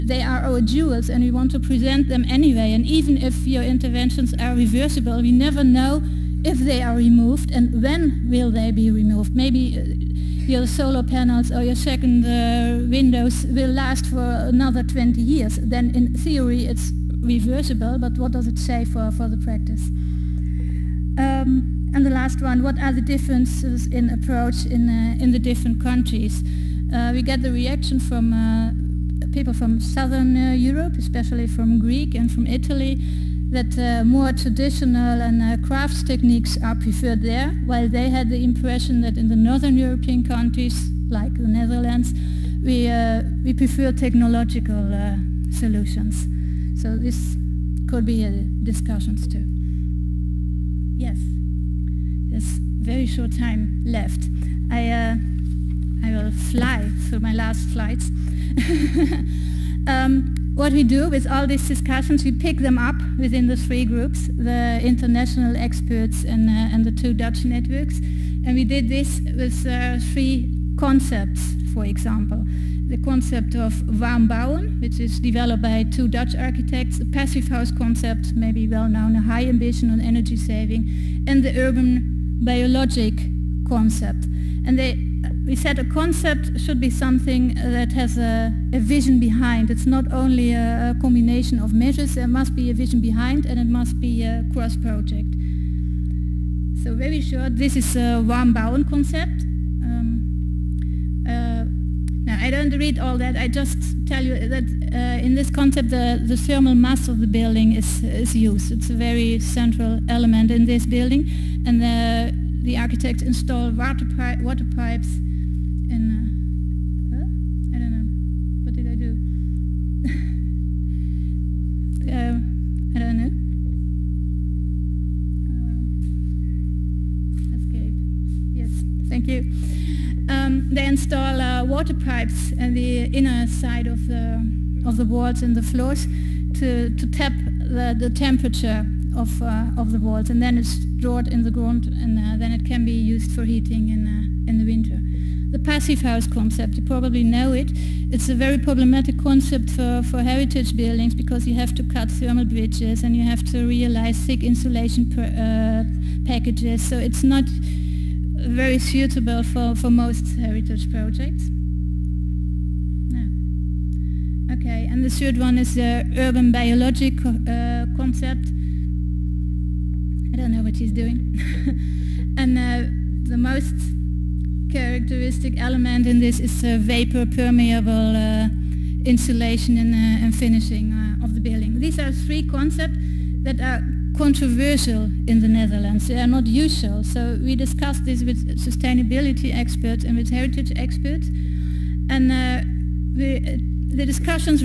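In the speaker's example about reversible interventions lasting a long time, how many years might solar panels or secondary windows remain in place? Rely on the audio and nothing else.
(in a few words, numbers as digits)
20.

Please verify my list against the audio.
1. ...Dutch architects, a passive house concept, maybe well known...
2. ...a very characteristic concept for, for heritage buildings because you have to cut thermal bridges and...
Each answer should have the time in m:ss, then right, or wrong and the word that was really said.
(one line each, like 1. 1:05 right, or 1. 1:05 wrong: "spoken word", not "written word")
1. 1:16 right
2. 2:28 wrong: "problematic", not "characteristic".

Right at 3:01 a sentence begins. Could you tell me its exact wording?
These are three concepts that are controversial in the Netherlands.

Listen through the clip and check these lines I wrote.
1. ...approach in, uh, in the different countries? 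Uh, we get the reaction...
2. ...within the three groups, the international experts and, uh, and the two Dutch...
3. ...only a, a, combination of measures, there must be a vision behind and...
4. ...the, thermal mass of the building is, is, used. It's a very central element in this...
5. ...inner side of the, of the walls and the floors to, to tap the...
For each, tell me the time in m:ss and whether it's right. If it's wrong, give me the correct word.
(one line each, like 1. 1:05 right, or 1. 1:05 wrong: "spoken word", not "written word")
1. 0:24 right
2. 1:03 right
3. 1:30 right
4. 1:46 right
5. 2:13 right.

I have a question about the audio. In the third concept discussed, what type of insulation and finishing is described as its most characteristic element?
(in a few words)
Vapor permeable.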